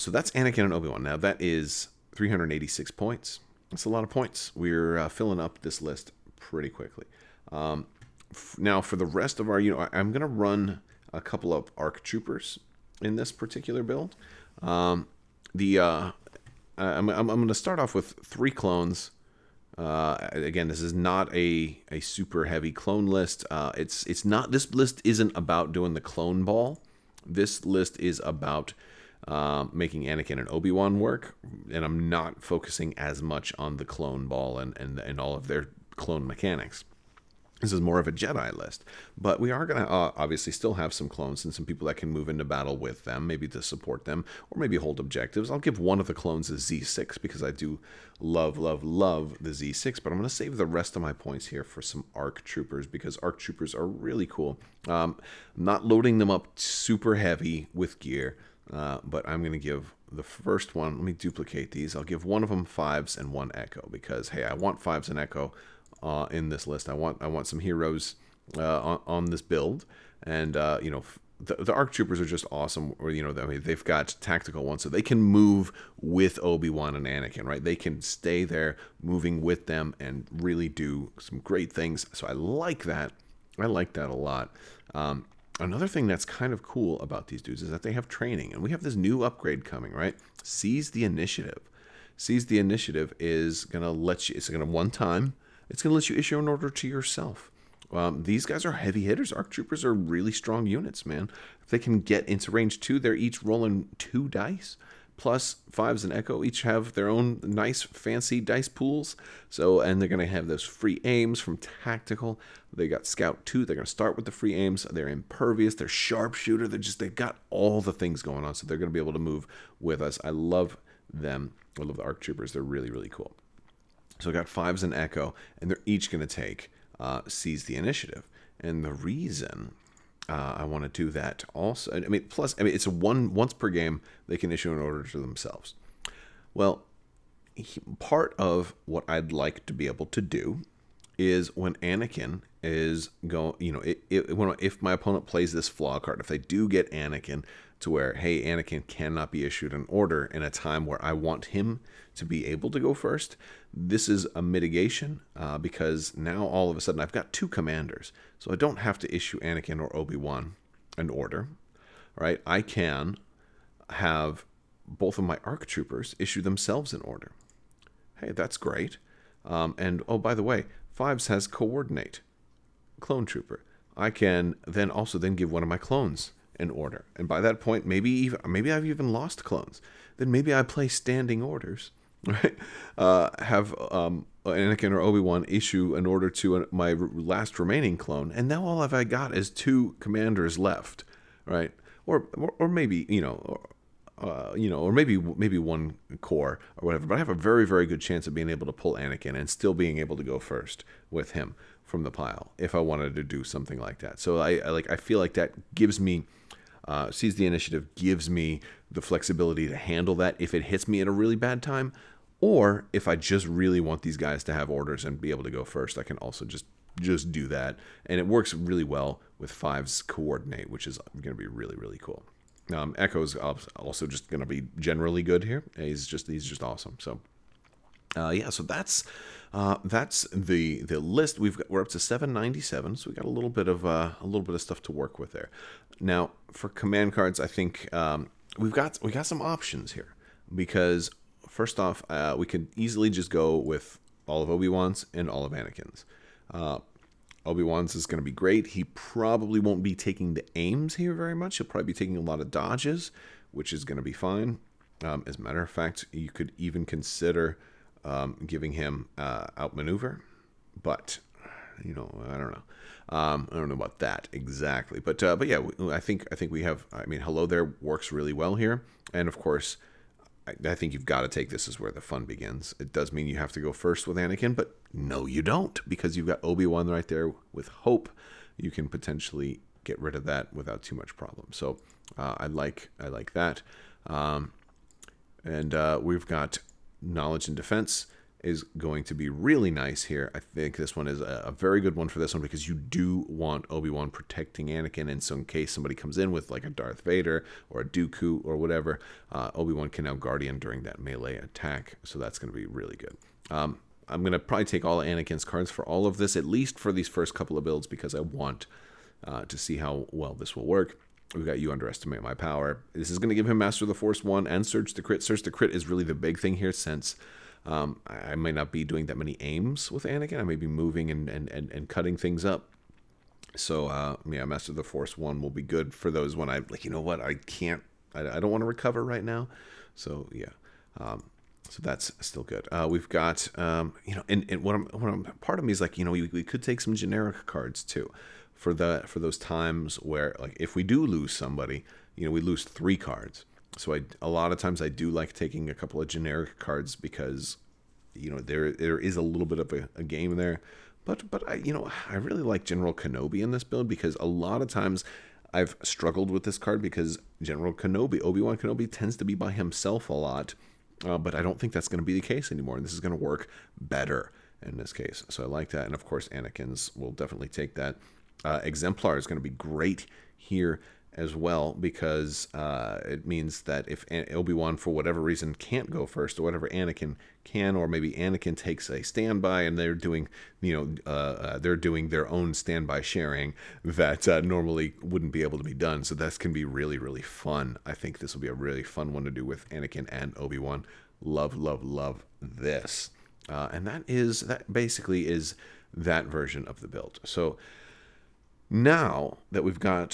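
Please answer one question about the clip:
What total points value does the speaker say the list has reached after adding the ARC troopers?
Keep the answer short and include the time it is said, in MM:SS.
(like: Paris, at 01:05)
797, at 03:52.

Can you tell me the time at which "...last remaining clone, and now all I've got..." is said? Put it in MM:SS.
03:06.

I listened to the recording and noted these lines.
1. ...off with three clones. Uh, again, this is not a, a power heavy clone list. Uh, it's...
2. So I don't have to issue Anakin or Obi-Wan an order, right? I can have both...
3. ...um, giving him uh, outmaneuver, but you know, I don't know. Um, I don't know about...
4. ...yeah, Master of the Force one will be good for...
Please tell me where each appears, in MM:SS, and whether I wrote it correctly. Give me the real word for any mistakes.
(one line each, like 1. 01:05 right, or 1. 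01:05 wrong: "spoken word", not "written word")
1. 00:17 wrong: "super", not "power"
2. 02:38 right
3. 04:18 right
4. 05:24 right.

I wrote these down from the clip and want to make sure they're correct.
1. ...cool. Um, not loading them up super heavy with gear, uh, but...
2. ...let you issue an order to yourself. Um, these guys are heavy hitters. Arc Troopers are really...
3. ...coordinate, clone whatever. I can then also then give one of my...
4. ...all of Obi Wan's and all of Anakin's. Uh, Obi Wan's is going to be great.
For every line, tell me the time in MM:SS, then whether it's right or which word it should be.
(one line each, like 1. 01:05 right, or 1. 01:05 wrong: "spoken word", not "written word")
1. 00:54 right
2. 01:35 right
3. 02:51 wrong: "trooper", not "whatever"
4. 04:04 right.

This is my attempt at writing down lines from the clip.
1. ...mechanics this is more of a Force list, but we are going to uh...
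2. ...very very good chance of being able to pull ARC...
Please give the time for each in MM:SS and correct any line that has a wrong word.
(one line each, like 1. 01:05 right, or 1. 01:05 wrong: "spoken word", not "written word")
1. 00:36 wrong: "Jedi", not "Force"
2. 03:17 wrong: "Anakin", not "ARC".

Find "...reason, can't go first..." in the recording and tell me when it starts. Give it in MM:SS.
06:15.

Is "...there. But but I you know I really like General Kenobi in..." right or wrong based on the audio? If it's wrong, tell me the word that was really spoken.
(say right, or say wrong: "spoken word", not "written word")
right.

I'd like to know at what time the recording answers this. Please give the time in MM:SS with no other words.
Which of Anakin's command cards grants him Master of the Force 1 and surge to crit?
05:11.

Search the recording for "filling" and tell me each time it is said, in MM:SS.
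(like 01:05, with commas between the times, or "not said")
00:05.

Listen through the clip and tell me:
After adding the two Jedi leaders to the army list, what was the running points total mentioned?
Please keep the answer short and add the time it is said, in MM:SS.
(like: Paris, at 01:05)
386, at 00:02.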